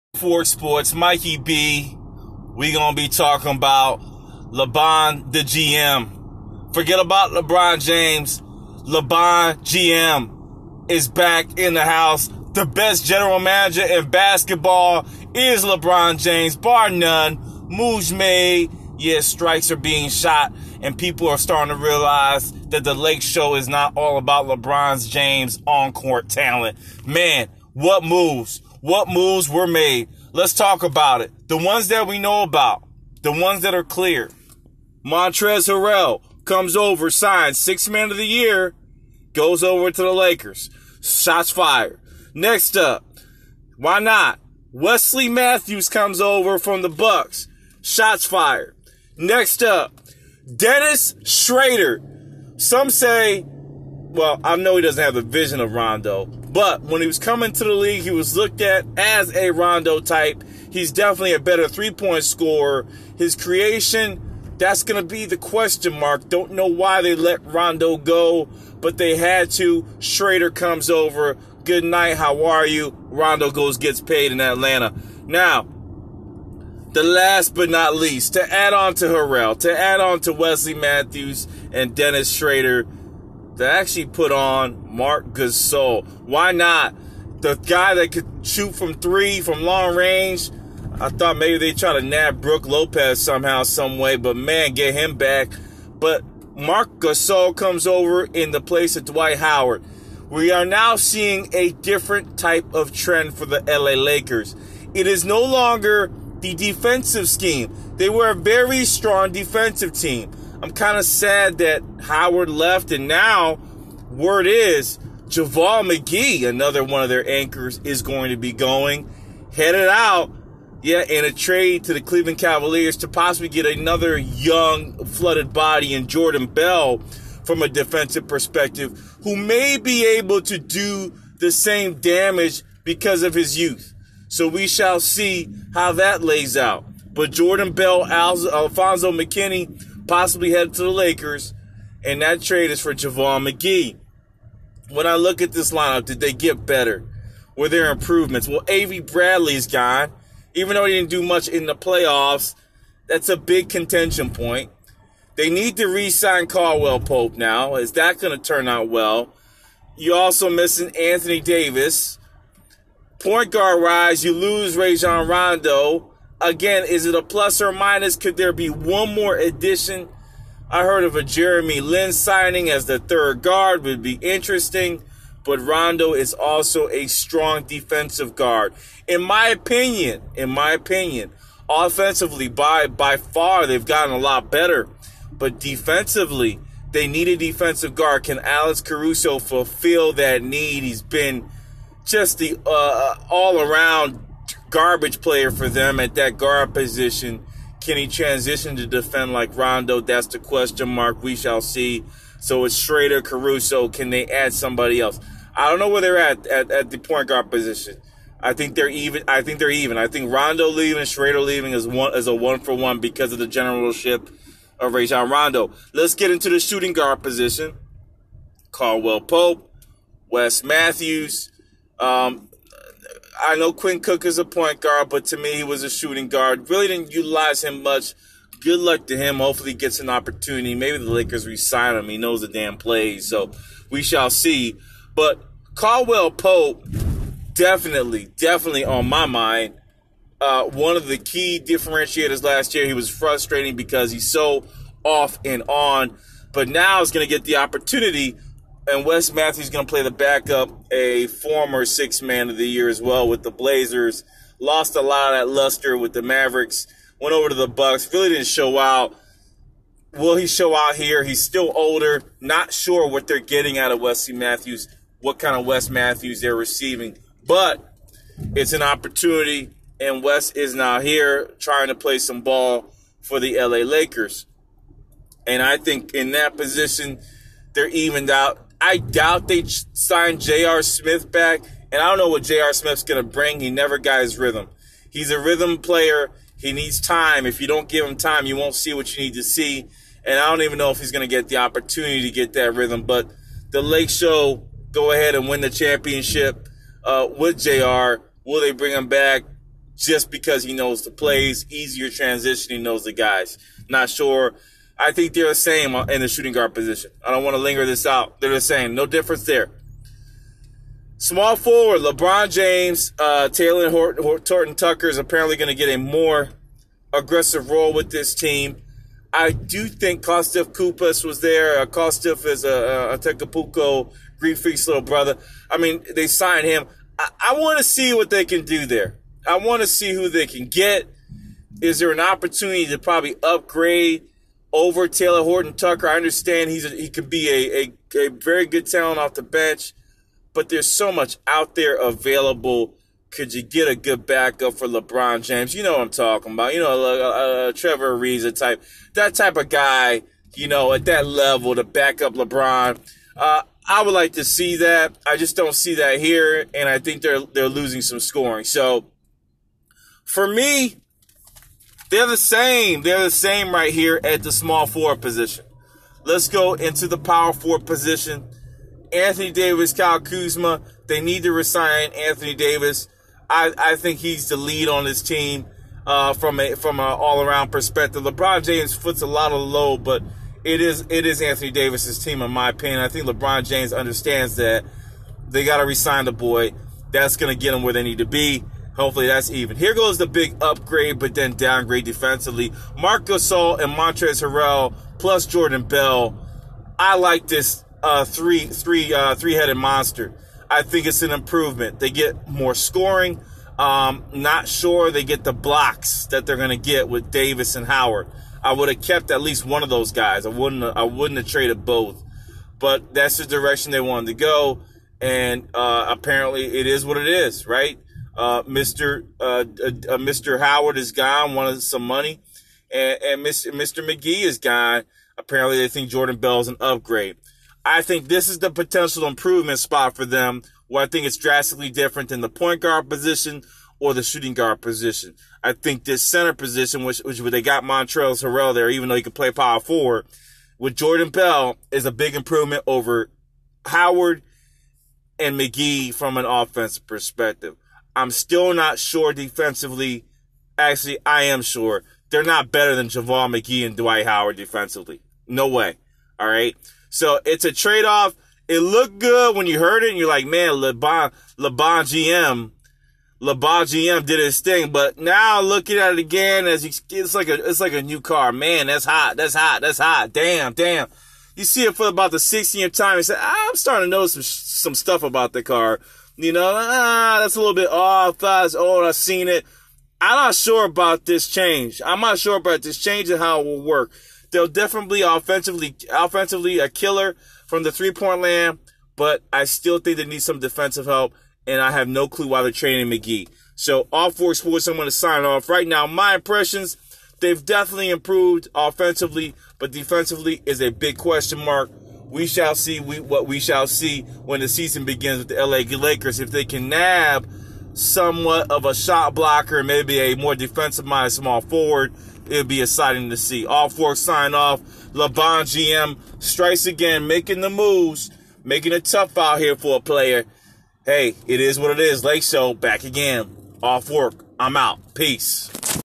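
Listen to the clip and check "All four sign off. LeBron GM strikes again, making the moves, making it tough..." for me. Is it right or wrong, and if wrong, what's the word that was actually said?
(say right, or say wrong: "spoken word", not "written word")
right.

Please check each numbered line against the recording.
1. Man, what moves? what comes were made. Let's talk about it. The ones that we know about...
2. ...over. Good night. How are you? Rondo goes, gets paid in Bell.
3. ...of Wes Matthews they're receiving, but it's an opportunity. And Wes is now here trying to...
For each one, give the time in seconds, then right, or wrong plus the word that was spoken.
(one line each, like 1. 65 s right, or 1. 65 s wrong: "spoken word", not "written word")
1. 27 s wrong: "moves", not "comes"
2. 70 s wrong: "Atlanta", not "Bell"
3. 265 s right.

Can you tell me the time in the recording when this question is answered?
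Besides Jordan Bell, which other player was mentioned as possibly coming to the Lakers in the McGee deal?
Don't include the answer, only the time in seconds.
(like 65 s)
138 s.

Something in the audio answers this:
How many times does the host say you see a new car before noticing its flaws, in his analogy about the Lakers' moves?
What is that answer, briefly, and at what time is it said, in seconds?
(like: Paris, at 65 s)
16, at 472 s.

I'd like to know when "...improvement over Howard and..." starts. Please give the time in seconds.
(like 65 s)
442 s.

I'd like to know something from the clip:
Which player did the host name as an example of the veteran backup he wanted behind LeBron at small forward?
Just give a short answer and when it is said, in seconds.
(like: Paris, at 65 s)
Trevor Ariza, at 347 s.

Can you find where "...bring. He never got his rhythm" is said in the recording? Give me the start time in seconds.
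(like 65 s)
283 s.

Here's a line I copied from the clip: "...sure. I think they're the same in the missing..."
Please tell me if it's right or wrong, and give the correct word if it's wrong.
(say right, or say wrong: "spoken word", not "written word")
wrong: "shooting", not "missing".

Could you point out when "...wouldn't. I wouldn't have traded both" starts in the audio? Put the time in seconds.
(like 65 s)
410 s.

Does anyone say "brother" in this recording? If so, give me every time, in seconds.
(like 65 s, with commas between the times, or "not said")
325 s.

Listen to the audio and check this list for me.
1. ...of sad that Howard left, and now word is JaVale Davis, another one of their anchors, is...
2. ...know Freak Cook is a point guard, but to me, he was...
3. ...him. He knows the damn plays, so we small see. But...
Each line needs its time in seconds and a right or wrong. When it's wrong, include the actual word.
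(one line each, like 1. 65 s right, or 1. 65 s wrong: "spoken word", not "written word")
1. 110 s wrong: "McGee", not "Davis"
2. 223 s wrong: "Quinn", not "Freak"
3. 231 s wrong: "shall", not "small".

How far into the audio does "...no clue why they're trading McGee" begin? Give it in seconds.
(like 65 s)
492 s.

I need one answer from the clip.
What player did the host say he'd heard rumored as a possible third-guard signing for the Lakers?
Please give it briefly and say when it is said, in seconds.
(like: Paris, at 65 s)
Jeremy Lin, at 171 s.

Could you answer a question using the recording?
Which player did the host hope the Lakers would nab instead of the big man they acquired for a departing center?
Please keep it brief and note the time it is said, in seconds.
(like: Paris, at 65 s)
Brook Lopez, at 92 s.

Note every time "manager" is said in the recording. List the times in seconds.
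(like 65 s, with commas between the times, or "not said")
13 s.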